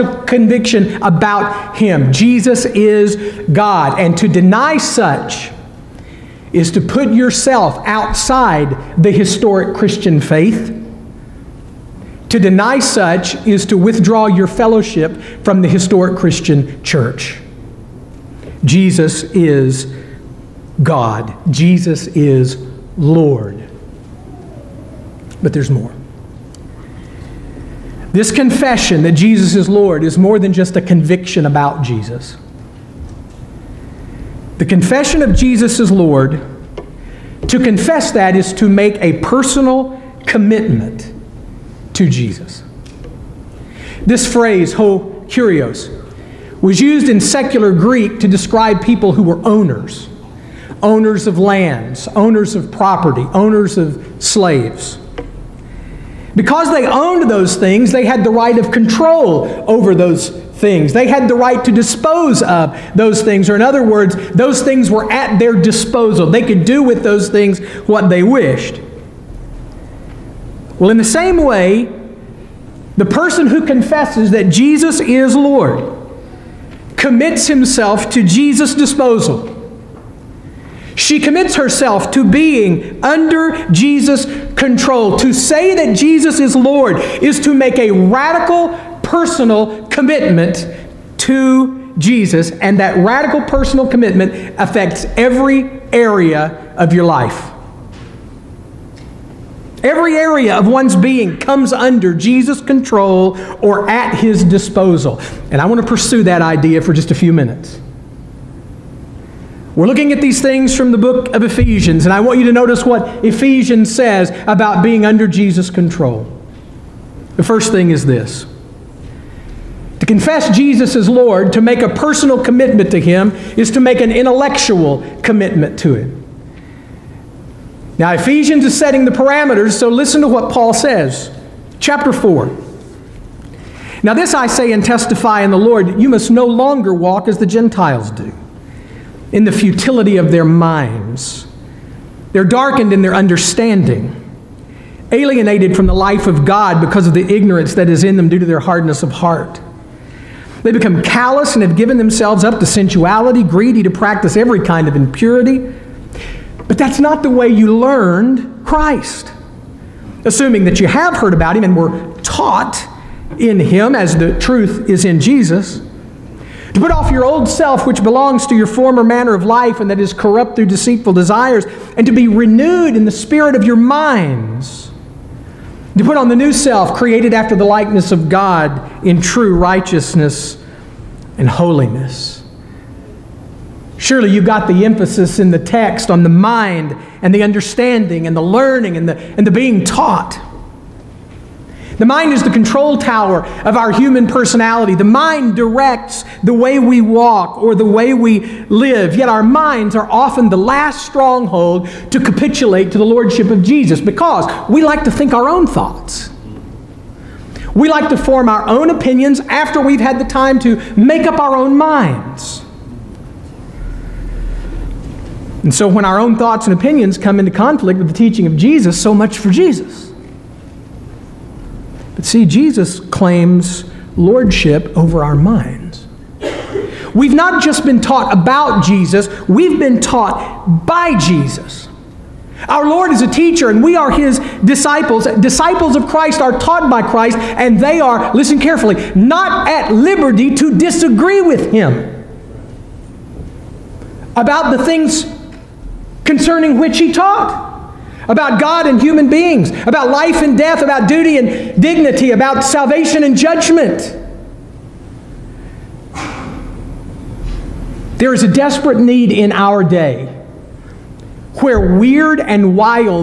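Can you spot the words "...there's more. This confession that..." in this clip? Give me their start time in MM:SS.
00:25.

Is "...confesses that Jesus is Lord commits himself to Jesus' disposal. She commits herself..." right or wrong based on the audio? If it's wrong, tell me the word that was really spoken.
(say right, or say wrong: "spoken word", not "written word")
right.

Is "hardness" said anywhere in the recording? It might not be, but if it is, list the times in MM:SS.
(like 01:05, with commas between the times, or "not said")
02:28.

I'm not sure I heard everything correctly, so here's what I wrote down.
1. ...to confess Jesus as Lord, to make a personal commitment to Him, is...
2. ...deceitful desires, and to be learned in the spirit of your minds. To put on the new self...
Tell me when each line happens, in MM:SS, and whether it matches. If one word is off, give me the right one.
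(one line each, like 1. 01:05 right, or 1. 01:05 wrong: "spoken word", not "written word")
1. 02:00 right
2. 02:50 wrong: "renewed", not "learned".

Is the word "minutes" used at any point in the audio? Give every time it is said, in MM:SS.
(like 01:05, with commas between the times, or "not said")
01:47.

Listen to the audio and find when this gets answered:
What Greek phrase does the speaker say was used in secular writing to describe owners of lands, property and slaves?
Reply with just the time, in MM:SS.
00:44.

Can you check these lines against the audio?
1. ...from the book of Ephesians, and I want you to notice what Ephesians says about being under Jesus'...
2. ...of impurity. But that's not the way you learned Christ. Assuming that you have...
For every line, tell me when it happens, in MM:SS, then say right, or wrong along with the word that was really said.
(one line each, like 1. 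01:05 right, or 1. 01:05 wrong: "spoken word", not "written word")
1. 01:50 right
2. 02:34 right.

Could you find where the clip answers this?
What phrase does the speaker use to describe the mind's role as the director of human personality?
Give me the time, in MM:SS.
03:12.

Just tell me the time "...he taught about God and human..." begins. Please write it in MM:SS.
04:06.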